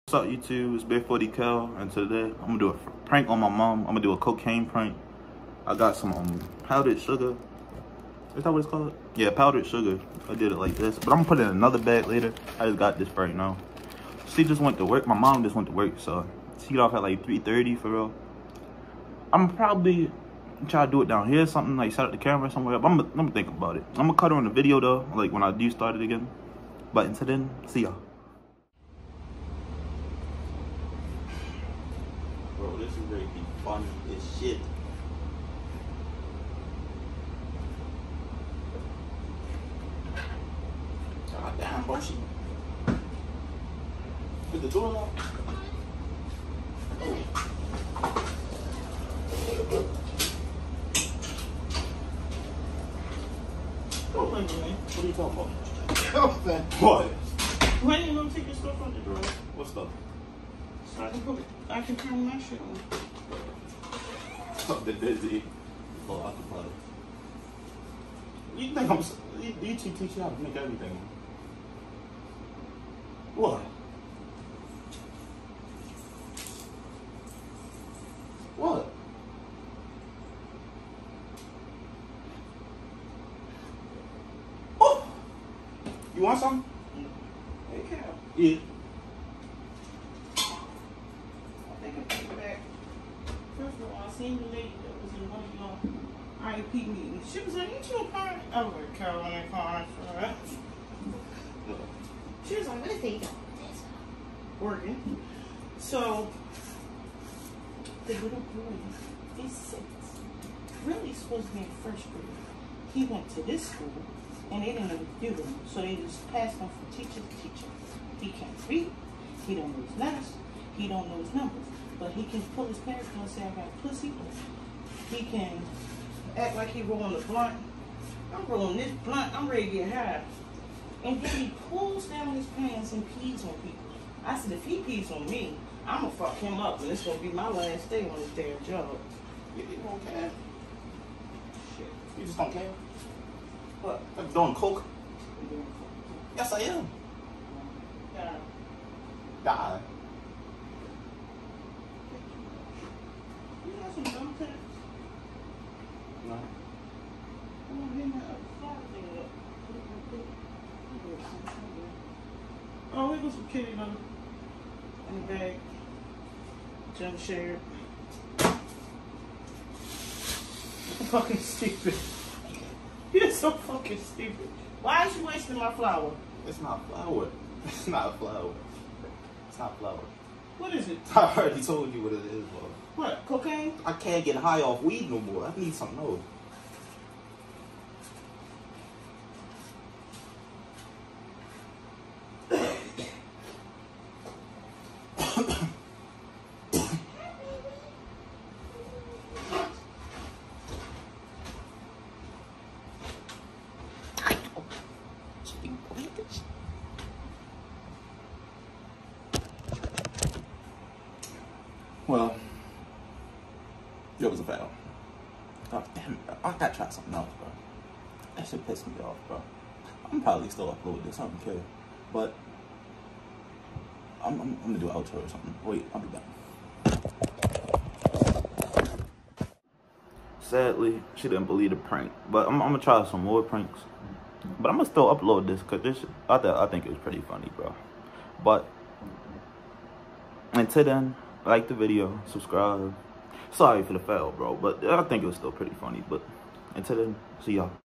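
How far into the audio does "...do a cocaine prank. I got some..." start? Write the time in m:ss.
0:04.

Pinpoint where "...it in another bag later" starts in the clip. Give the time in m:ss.
0:11.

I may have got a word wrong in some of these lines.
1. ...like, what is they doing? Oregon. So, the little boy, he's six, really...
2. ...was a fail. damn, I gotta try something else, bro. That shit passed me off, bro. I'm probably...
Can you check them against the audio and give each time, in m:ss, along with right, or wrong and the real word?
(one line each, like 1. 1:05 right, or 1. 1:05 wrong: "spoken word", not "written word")
1. 1:42 right
2. 3:34 wrong: "pissed", not "passed".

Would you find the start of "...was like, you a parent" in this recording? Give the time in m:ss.
1:37.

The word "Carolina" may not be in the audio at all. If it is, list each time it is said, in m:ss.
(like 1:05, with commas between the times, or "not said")
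1:38.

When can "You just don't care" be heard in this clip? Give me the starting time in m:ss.
2:22.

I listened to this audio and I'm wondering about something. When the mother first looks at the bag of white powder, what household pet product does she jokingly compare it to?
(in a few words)
kitty litter.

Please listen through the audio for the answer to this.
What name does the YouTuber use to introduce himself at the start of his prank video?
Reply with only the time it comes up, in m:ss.
0:00.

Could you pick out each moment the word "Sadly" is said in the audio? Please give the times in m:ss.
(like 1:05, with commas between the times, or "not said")
3:50.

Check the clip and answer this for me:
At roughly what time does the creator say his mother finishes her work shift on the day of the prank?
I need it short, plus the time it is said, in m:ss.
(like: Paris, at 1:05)
3:30, at 0:17.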